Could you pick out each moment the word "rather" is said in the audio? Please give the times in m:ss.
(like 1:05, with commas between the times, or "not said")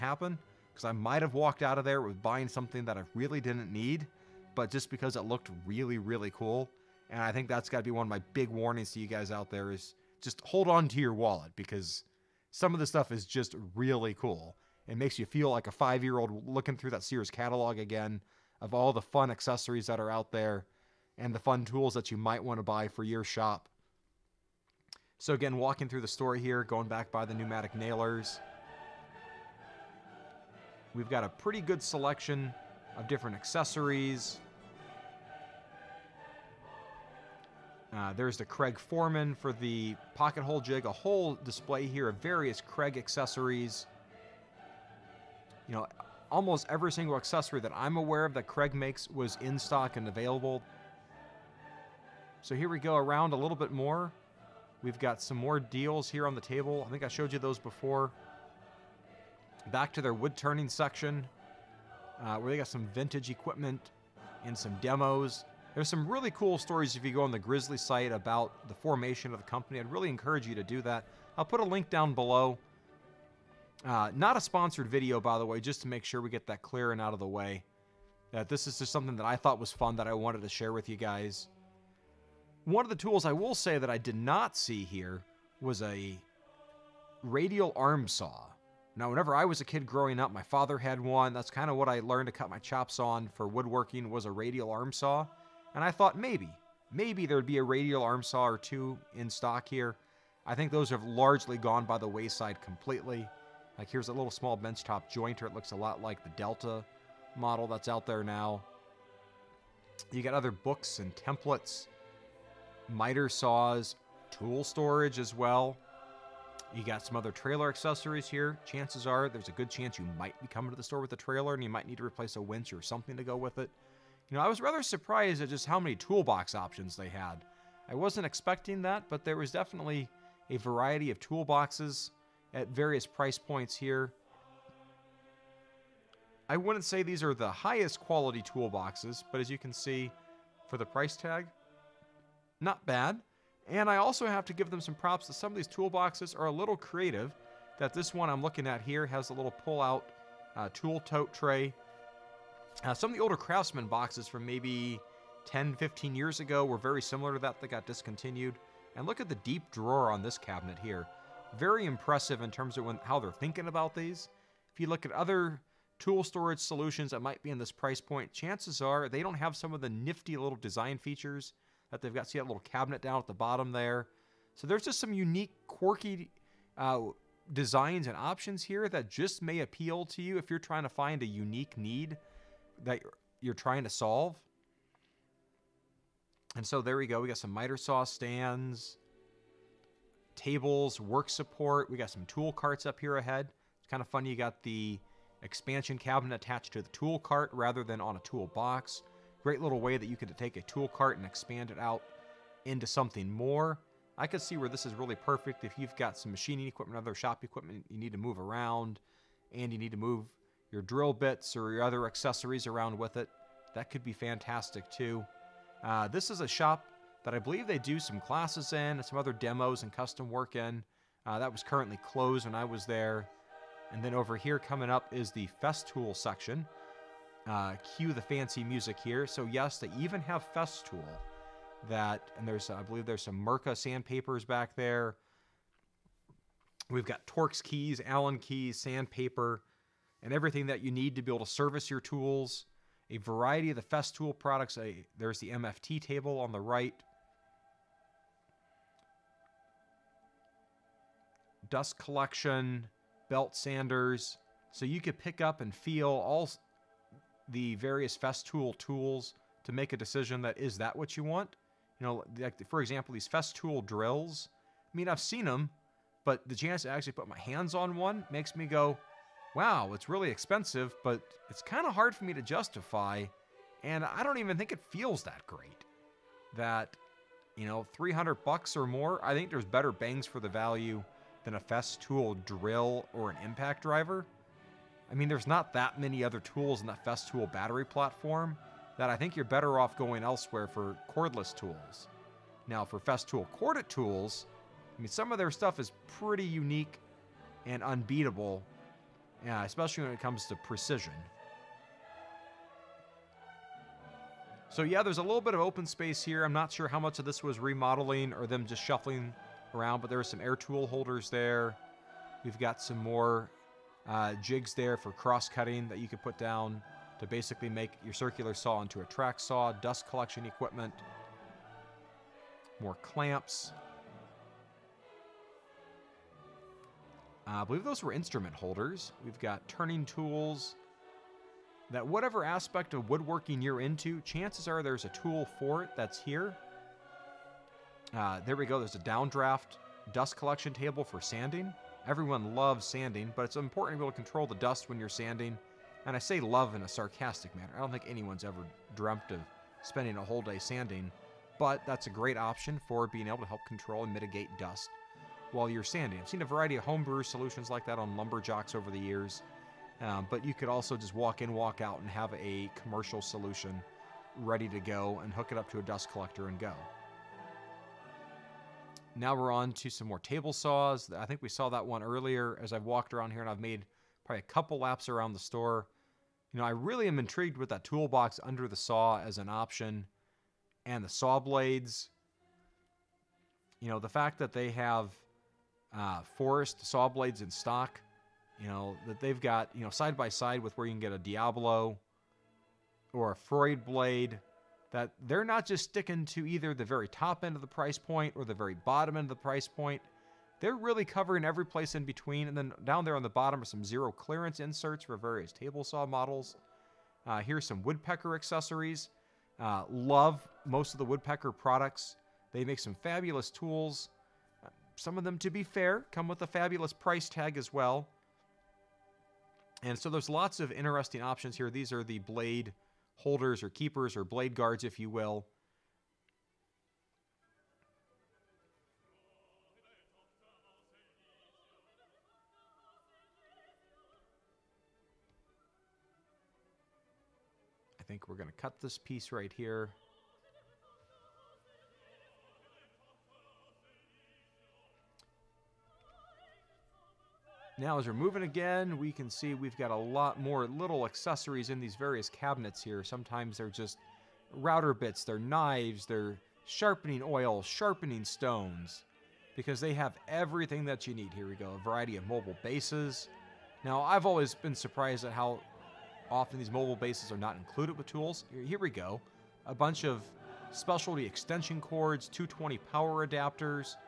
2:04, 3:17.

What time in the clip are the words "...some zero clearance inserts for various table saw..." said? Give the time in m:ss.
6:43.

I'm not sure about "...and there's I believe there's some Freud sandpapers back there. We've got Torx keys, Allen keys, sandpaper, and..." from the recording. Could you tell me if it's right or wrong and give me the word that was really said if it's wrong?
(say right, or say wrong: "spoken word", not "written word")
wrong: "Mirka", not "Freud".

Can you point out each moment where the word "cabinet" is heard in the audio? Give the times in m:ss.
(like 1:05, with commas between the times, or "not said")
2:40, 2:52, 3:15, 7:32.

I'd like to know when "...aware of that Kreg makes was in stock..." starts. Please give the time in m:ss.
0:47.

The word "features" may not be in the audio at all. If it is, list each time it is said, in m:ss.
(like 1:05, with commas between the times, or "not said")
2:50.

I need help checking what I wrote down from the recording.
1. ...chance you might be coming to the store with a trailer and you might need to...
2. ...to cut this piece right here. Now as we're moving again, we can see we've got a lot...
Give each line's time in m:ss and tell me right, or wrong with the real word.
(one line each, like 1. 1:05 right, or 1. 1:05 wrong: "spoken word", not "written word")
1. 1:59 right
2. 7:18 right.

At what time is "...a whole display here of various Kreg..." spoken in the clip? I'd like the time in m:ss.
0:40.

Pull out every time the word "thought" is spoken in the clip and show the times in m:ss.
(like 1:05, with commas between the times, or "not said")
1:19, 1:35.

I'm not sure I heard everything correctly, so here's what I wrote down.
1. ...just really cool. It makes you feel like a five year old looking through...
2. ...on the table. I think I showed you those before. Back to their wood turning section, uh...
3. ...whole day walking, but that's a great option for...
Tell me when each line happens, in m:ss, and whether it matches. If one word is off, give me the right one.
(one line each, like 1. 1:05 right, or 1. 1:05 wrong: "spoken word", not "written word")
1. 0:13 right
2. 0:56 right
3. 5:50 wrong: "sanding", not "walking".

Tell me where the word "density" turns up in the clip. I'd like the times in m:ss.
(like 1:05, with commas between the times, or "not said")
not said.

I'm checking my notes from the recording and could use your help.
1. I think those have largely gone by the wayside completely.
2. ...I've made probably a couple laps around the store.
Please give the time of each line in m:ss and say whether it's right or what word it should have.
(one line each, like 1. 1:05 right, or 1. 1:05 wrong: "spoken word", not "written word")
1. 1:40 right
2. 6:13 right.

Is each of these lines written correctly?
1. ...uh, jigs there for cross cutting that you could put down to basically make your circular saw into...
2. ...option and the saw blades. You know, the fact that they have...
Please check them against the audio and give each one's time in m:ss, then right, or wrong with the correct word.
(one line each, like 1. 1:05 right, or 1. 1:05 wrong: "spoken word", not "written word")
1. 5:14 right
2. 6:19 right.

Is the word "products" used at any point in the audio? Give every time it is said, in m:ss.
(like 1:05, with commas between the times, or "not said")
4:04, 6:51.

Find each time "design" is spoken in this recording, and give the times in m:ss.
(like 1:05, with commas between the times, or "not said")
2:50, 2:57.